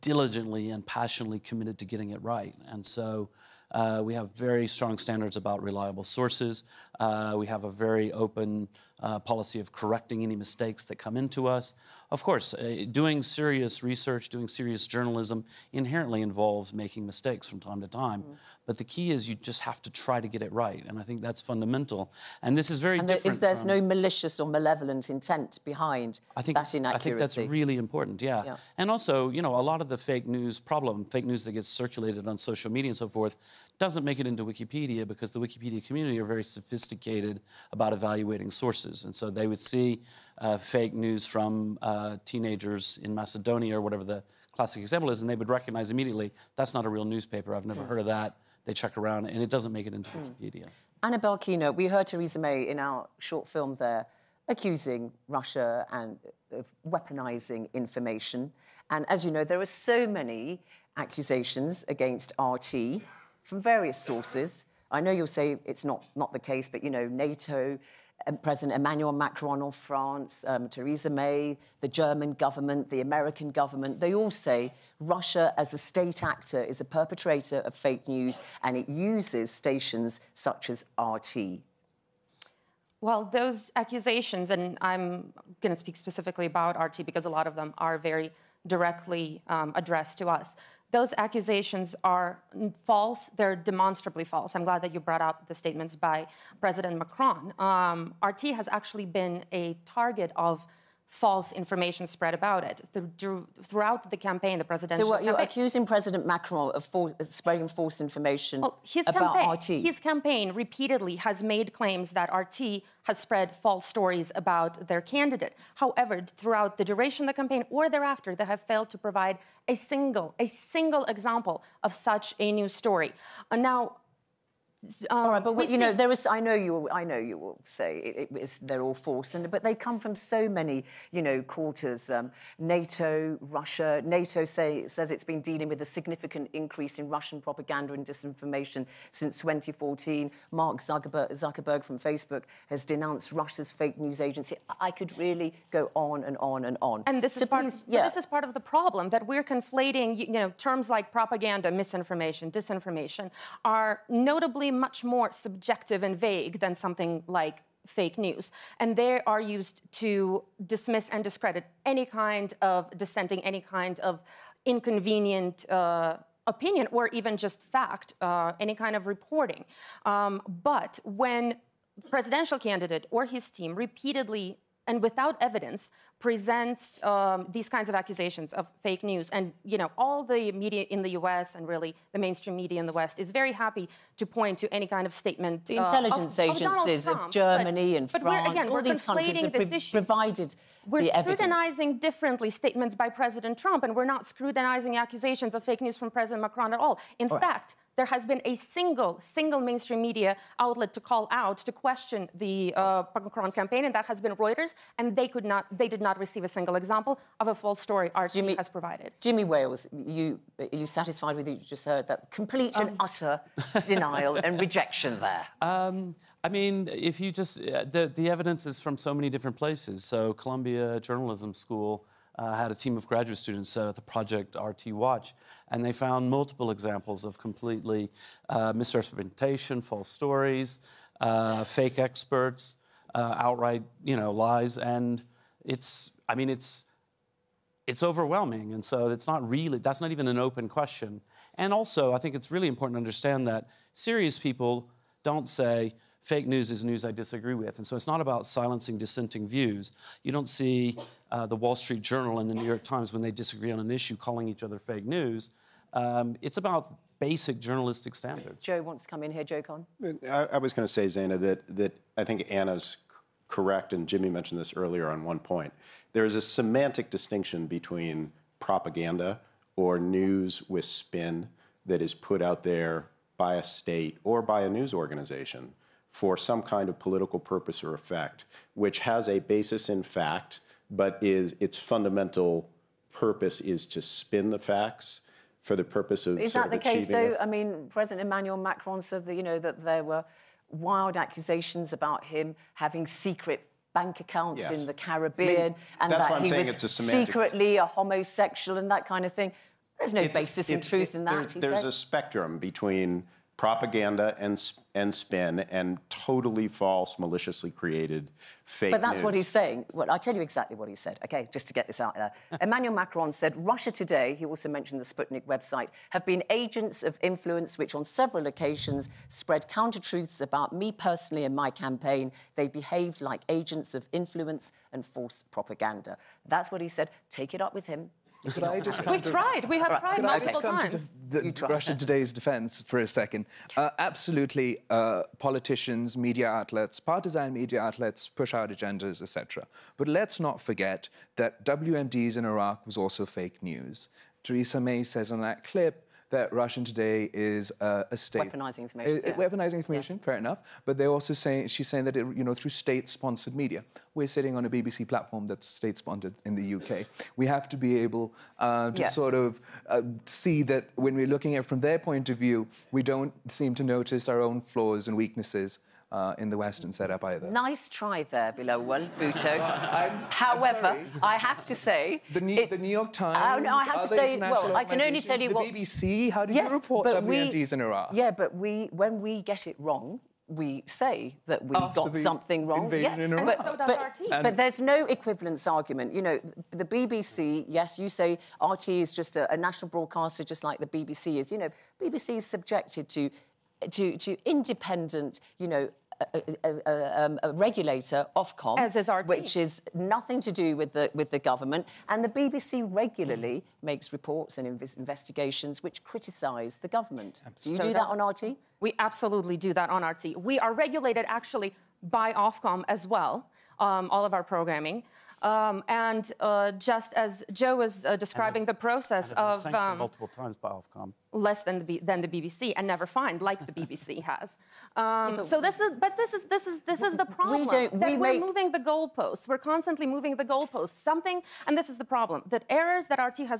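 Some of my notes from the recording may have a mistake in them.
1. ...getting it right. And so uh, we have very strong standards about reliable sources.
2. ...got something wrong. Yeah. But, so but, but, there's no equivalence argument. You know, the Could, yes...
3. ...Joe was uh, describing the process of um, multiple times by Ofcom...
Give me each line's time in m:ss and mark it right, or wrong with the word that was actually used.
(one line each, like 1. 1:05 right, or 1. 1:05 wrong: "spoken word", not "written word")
1. 0:01 right
2. 6:22 wrong: "BBC", not "Could"
3. 6:57 right.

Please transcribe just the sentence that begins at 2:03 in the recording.
And now, um, all right, um, but you see...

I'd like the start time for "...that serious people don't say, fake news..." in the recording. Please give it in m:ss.
4:03.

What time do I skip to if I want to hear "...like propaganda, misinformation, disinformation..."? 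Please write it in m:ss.
2:30.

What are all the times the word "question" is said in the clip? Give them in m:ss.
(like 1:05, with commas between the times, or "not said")
3:21, 4:00.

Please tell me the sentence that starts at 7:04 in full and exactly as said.
Um, yeah, so this is, but this is this is this is the problem we that we we're moving the goalposts.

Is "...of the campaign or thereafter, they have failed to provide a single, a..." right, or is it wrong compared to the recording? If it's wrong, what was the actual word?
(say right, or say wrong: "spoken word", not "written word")
right.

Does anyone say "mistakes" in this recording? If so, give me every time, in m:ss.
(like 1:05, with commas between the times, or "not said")
0:10, 0:17.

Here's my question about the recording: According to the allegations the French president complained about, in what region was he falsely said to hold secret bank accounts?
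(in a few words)
the Caribbean.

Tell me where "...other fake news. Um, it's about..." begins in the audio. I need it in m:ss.
4:14.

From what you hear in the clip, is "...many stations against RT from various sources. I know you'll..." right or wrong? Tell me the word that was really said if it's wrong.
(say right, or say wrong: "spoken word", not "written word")
wrong: "accusations", not "stations".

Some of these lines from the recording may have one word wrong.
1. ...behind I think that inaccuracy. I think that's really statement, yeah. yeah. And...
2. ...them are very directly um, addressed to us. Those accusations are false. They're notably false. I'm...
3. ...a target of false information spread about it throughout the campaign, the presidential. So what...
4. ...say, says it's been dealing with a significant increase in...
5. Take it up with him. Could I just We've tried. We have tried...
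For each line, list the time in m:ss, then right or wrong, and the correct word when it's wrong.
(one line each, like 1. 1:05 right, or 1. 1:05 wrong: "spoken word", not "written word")
1. 0:25 wrong: "important", not "statement"
2. 1:27 wrong: "demonstrably", not "notably"
3. 1:39 right
4. 2:14 right
5. 5:27 right.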